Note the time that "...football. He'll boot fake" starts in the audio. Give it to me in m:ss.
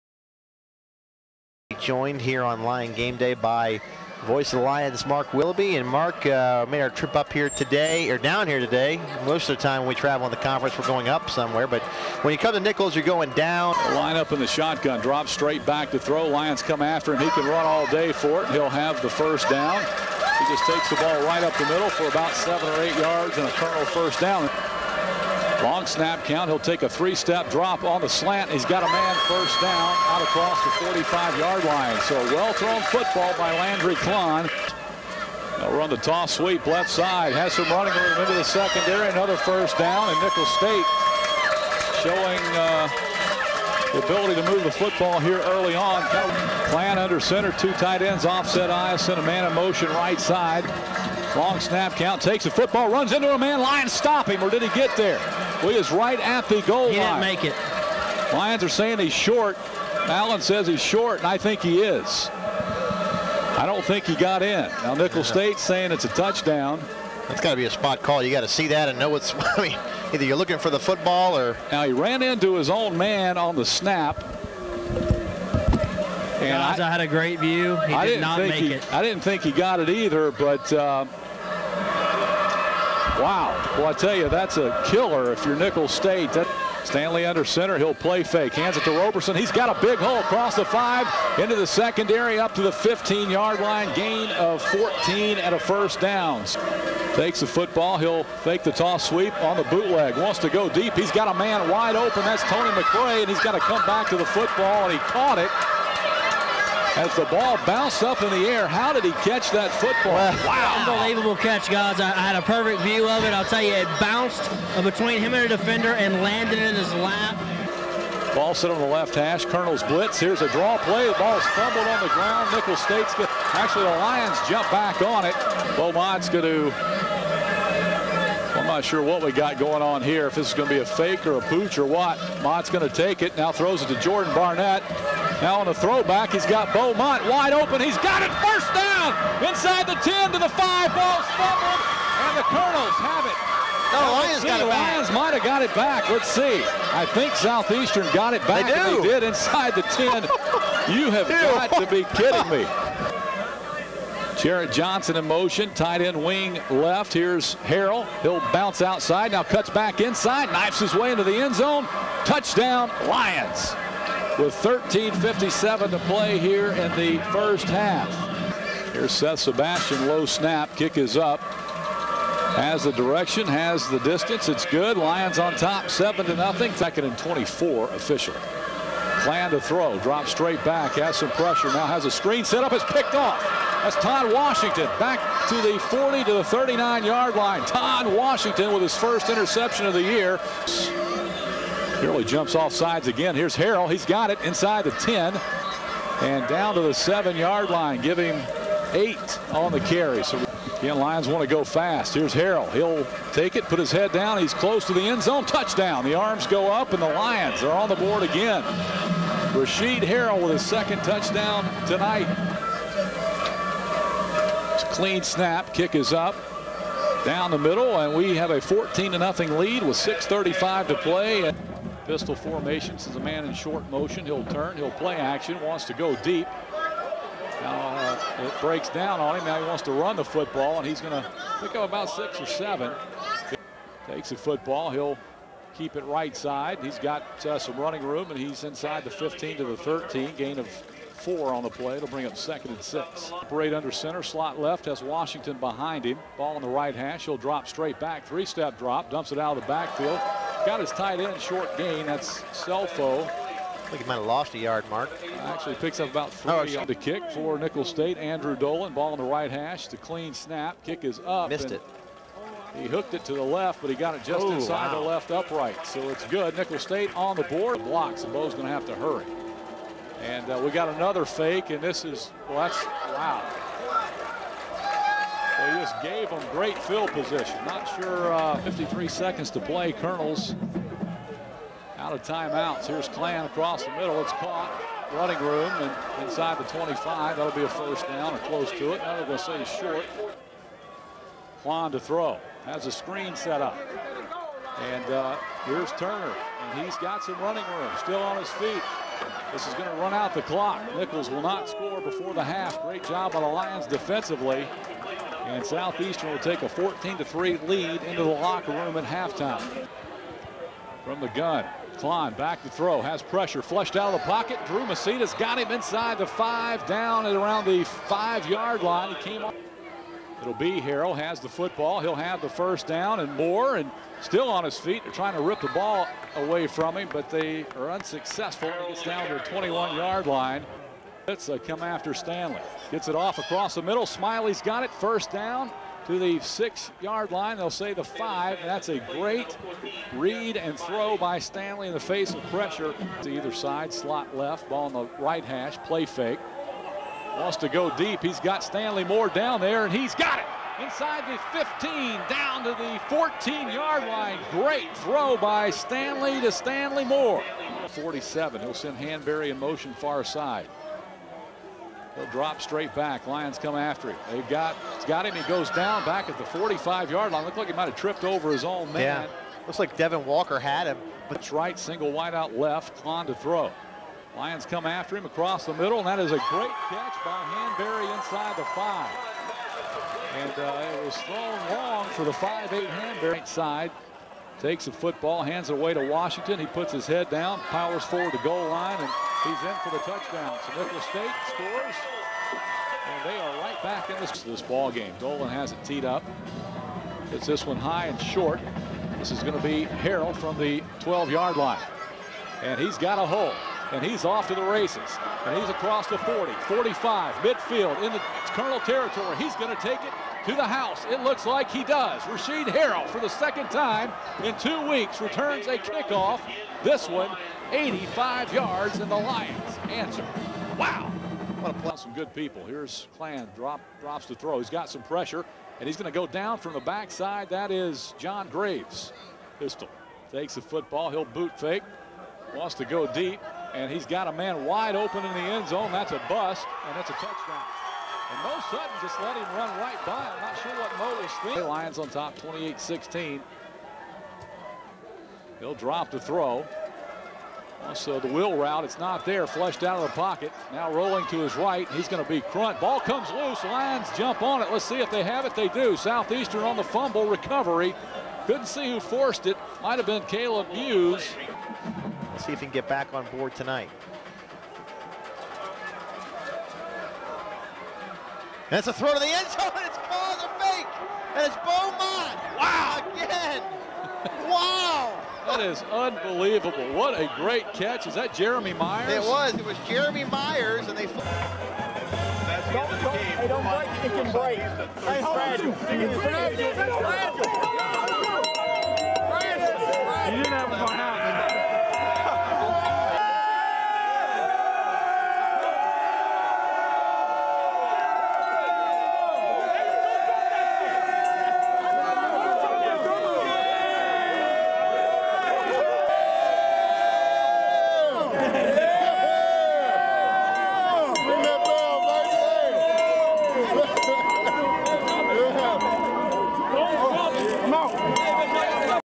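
7:10.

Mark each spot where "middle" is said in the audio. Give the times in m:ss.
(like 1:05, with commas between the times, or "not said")
0:21, 3:37, 4:43, 5:33, 6:15.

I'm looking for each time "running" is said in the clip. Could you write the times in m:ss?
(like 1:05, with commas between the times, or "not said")
0:37, 3:57, 4:45, 4:57.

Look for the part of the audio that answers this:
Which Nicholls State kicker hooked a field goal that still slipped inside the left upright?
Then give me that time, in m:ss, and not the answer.
4:18.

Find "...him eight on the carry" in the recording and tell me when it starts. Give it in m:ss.
3:18.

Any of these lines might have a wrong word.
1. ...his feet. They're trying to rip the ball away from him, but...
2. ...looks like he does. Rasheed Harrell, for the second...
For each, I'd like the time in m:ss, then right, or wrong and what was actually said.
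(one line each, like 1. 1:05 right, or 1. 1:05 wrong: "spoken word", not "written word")
1. 5:24 right
2. 6:51 right.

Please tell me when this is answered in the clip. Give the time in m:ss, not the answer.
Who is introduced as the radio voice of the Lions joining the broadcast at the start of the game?
0:05.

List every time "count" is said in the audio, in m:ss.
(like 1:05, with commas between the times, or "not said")
0:26, 0:51.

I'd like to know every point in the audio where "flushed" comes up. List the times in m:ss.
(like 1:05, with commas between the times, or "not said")
5:13, 7:29.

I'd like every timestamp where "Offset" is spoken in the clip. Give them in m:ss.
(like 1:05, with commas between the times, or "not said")
0:48.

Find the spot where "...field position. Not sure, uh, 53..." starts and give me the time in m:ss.
4:36.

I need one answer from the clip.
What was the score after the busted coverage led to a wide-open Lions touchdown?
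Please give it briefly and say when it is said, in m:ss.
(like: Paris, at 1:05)
28-16, at 7:22.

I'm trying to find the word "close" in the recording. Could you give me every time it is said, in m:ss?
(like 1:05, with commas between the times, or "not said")
3:24, 4:48.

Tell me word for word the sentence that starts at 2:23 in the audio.
No, Lions got it Lions might have got it back.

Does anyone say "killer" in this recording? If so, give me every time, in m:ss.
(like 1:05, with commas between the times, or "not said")
1:24.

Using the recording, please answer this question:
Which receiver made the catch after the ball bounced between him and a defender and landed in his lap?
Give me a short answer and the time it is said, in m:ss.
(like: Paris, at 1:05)
Tony McRae, at 1:42.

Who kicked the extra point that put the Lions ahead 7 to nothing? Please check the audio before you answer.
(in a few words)
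Seth Sebastian.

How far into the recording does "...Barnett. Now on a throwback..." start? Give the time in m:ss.
2:14.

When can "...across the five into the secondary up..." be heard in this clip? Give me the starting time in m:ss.
1:30.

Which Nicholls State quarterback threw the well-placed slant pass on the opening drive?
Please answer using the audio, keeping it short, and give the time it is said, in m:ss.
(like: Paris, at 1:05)
Landry Klein, at 0:33.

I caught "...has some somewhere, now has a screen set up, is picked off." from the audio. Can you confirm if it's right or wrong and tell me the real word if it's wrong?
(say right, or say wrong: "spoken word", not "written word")
wrong: "pressure", not "somewhere".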